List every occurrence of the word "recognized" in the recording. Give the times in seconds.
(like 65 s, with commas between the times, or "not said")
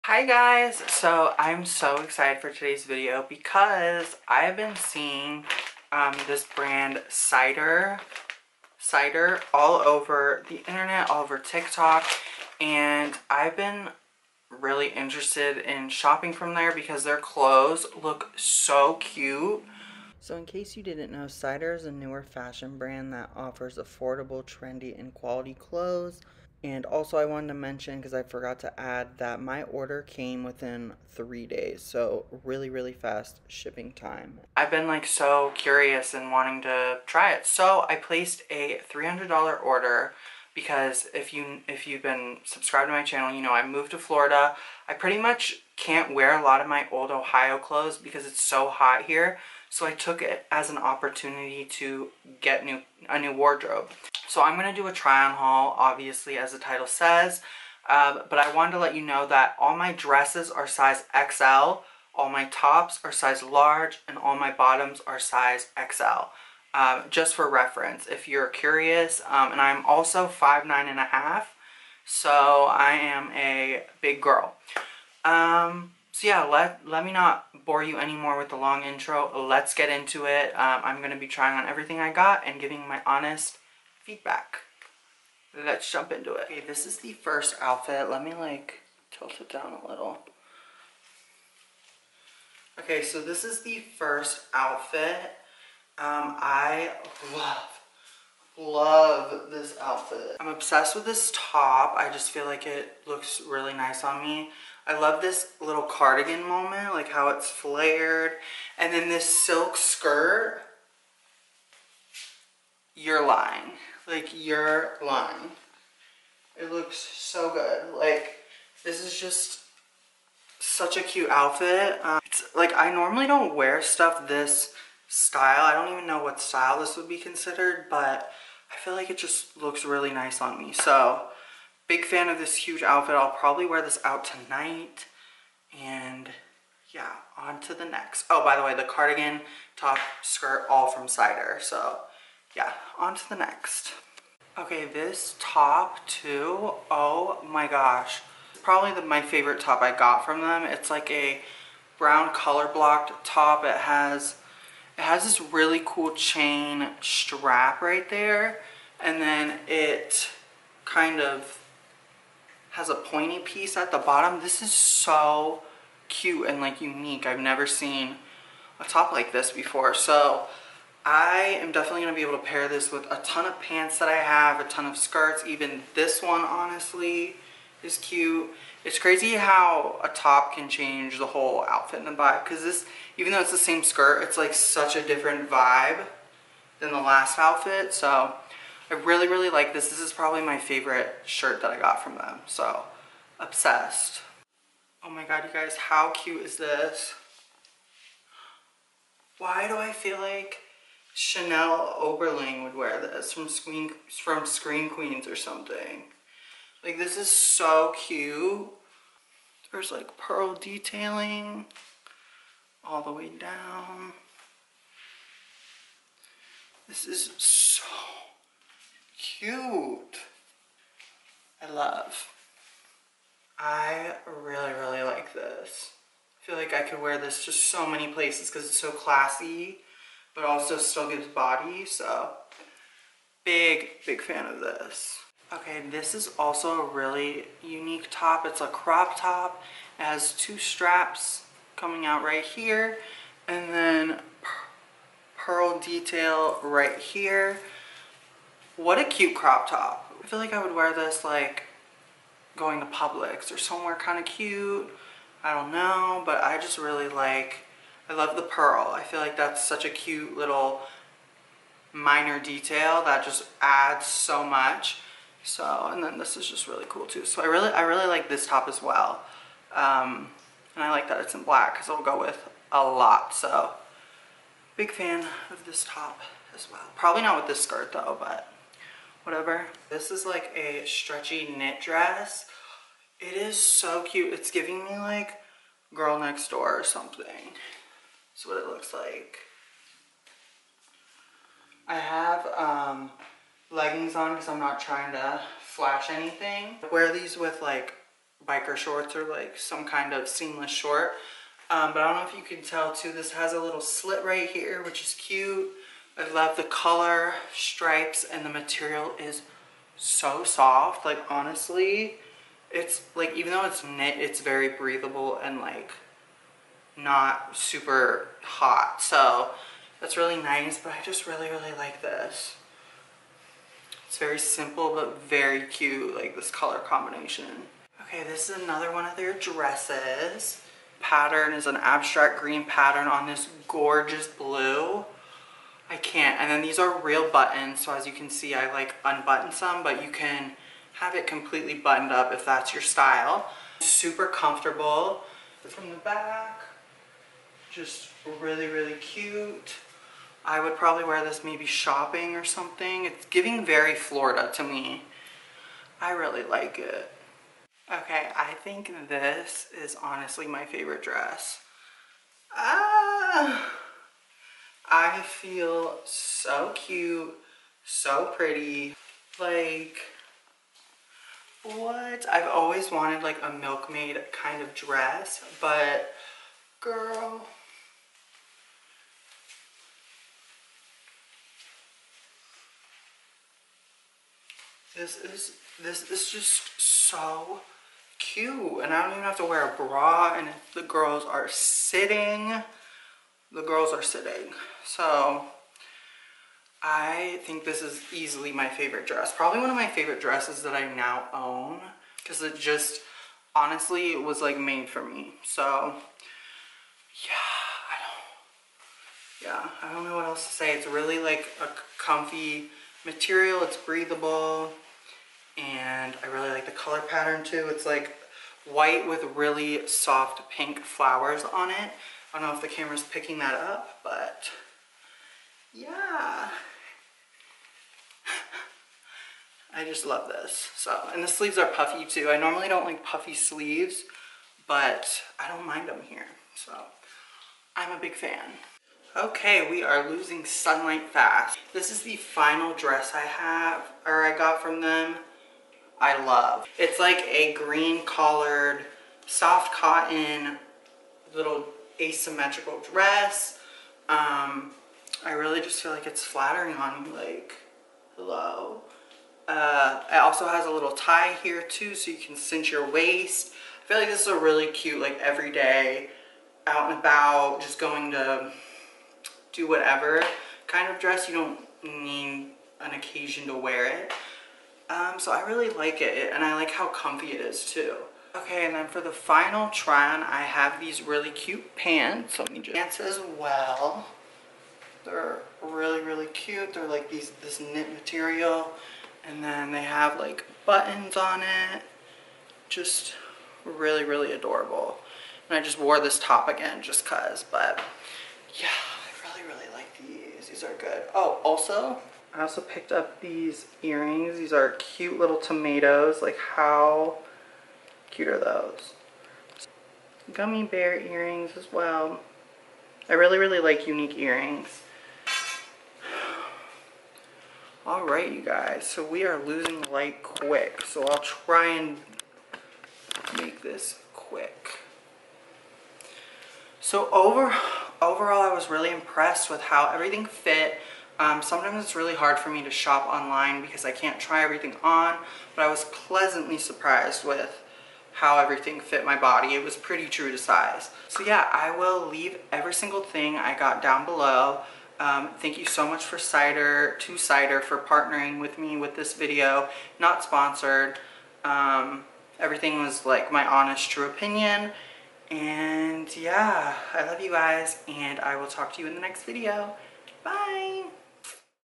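not said.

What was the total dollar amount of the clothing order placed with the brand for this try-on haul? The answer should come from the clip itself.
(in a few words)
$300.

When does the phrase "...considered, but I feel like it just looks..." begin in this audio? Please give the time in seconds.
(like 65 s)
127 s.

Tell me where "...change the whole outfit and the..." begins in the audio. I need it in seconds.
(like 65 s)
180 s.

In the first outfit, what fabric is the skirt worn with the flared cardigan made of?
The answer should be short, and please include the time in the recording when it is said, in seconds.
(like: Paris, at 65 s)
Silk, at 109 s.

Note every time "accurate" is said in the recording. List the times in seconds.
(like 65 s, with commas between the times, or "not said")
not said.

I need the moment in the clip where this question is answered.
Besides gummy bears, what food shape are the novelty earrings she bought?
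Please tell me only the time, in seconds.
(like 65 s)
505 s.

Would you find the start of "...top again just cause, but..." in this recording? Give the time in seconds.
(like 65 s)
496 s.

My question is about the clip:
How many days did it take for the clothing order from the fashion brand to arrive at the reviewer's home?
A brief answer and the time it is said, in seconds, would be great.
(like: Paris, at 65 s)
3, at 31 s.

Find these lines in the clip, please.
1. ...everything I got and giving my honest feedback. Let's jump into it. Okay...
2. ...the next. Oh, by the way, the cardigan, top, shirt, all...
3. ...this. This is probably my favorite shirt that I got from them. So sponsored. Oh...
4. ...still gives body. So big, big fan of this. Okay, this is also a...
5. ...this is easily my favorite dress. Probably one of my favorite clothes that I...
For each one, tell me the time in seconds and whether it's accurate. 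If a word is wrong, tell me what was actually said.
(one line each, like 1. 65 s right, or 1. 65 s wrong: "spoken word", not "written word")
1. 81 s right
2. 137 s wrong: "skirt", not "shirt"
3. 189 s wrong: "obsessed", not "sponsored"
4. 230 s right
5. 397 s wrong: "dresses", not "clothes".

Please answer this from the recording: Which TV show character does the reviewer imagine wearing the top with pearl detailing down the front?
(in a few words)
Chanel Oberlin.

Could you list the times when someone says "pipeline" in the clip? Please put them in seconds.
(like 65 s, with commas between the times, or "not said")
not said.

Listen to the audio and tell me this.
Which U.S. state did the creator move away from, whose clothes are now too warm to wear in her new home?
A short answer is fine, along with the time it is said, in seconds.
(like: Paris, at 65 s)
Ohio, at 47 s.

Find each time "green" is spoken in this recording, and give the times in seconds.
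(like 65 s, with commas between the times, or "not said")
332 s, 447 s.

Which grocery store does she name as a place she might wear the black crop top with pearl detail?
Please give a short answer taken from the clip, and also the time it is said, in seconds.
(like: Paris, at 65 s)
Publix, at 252 s.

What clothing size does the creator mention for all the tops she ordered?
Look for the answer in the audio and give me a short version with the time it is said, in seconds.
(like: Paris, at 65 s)
Large, at 63 s.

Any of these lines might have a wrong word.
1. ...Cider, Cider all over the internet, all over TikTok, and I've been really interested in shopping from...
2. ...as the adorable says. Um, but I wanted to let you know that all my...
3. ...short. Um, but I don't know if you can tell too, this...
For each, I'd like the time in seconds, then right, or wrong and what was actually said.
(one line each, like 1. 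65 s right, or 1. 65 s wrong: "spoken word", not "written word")
1. 7 s right
2. 56 s wrong: "title", not "adorable"
3. 300 s right.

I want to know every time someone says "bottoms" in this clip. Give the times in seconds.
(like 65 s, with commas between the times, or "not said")
64 s, 163 s.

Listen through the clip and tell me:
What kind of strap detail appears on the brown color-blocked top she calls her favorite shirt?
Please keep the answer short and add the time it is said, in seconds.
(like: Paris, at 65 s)
Chain strap, at 156 s.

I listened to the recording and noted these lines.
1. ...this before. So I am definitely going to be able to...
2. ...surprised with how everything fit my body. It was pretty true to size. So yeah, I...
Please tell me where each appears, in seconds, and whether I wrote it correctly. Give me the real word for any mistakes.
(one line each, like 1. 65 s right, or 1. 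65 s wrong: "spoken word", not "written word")
1. 169 s right
2. 536 s right.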